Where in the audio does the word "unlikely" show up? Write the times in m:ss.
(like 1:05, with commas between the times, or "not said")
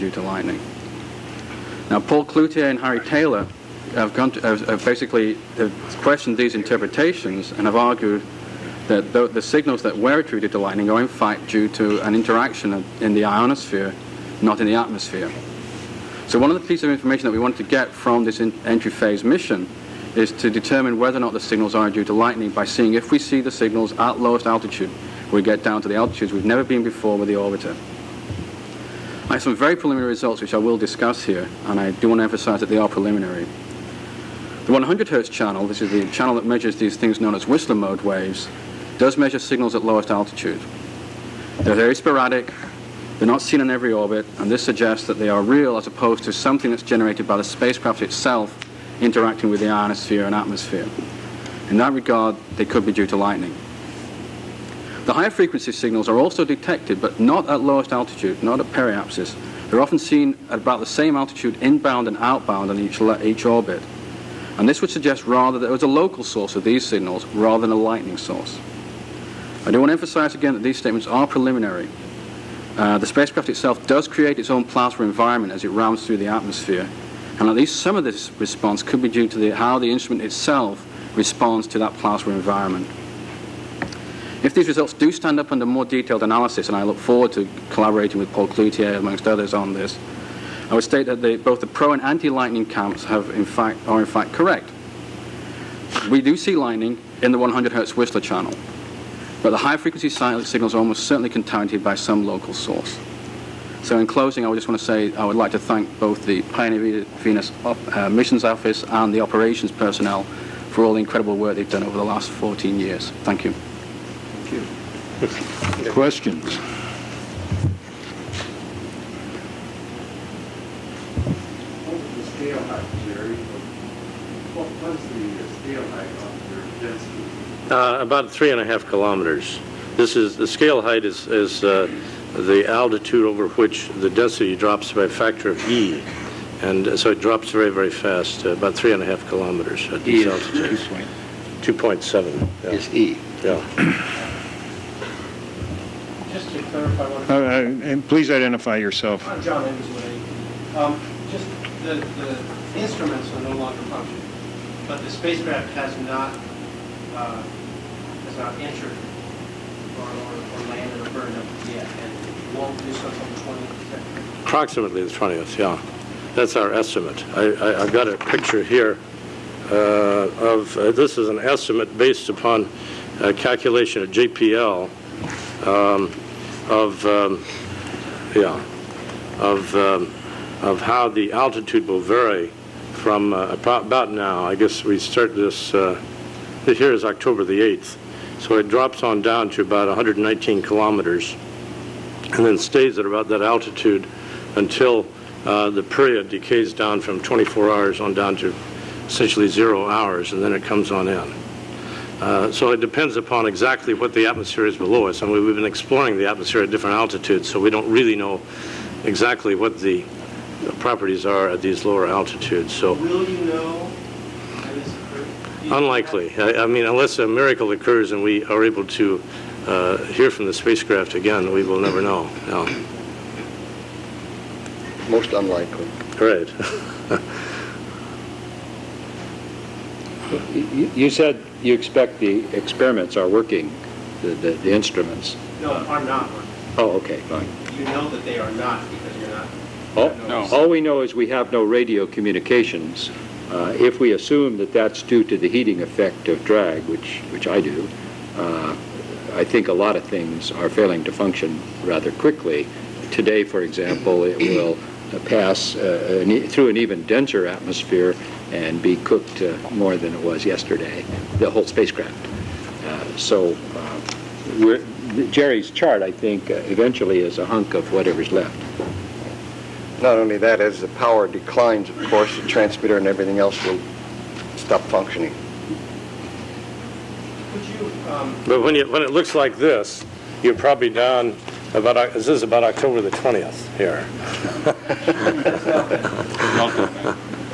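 3:35, 3:45.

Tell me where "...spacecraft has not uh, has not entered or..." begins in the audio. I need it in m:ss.
2:35.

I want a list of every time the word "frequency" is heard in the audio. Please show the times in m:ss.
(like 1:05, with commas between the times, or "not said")
0:55, 1:39.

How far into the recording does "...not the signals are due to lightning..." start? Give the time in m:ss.
0:21.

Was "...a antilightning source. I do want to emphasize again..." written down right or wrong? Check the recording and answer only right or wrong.
wrong.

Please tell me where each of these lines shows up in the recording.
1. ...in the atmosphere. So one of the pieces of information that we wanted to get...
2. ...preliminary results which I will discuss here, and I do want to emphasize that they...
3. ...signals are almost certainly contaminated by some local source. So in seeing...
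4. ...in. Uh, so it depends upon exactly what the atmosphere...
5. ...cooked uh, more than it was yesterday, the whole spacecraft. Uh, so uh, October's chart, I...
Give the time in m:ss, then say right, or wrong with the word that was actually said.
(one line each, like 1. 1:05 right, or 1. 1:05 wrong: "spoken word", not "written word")
1. 0:14 right
2. 0:29 right
3. 1:40 wrong: "closing", not "seeing"
4. 3:21 right
5. 4:18 wrong: "Jerry", not "October".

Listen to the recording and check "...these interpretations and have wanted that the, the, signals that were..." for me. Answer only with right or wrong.
wrong.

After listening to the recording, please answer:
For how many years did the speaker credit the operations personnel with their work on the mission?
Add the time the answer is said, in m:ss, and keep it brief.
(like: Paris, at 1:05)
14, at 1:52.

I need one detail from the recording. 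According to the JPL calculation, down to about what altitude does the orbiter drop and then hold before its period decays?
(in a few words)
119 kilometers.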